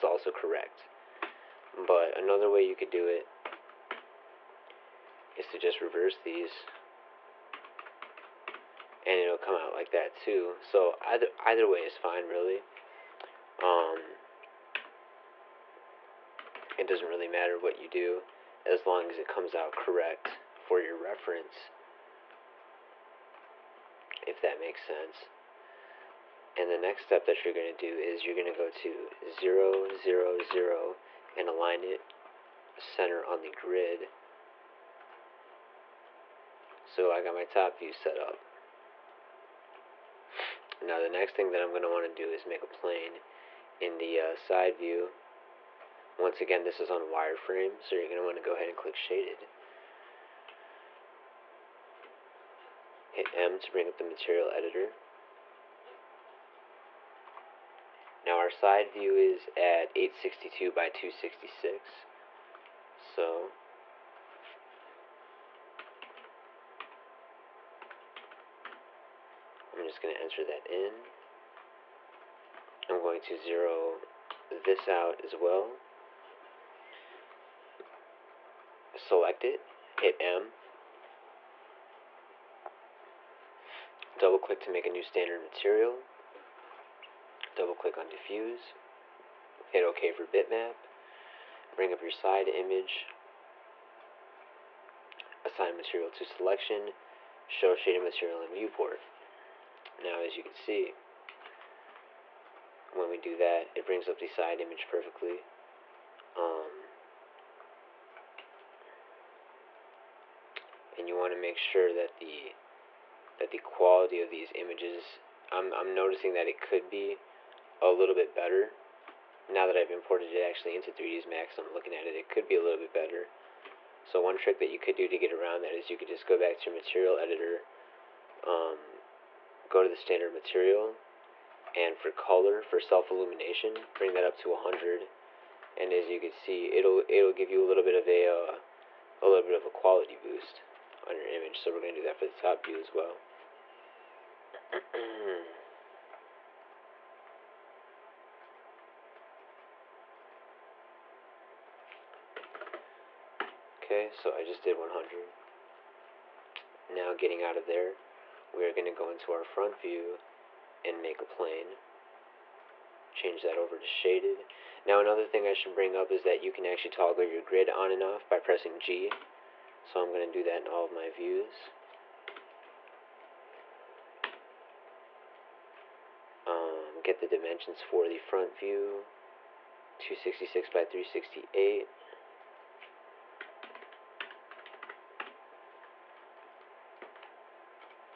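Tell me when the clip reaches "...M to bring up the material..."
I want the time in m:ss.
0:53.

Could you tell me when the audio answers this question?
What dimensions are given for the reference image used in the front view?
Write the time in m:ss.
2:59.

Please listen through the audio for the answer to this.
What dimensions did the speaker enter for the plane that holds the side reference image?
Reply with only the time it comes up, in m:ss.
0:59.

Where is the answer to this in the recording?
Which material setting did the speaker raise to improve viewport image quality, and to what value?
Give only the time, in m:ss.
2:12.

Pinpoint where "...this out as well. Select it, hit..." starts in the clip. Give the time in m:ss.
1:14.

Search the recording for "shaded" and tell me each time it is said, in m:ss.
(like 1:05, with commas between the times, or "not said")
0:48, 1:37, 2:43.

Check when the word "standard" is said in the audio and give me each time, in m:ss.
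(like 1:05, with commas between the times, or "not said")
1:25, 2:09.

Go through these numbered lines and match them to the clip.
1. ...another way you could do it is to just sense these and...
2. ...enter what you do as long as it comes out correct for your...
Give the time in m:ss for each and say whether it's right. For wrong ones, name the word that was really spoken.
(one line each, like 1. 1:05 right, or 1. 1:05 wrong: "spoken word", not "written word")
1. 0:02 wrong: "reverse", not "sense"
2. 0:17 wrong: "matter", not "enter".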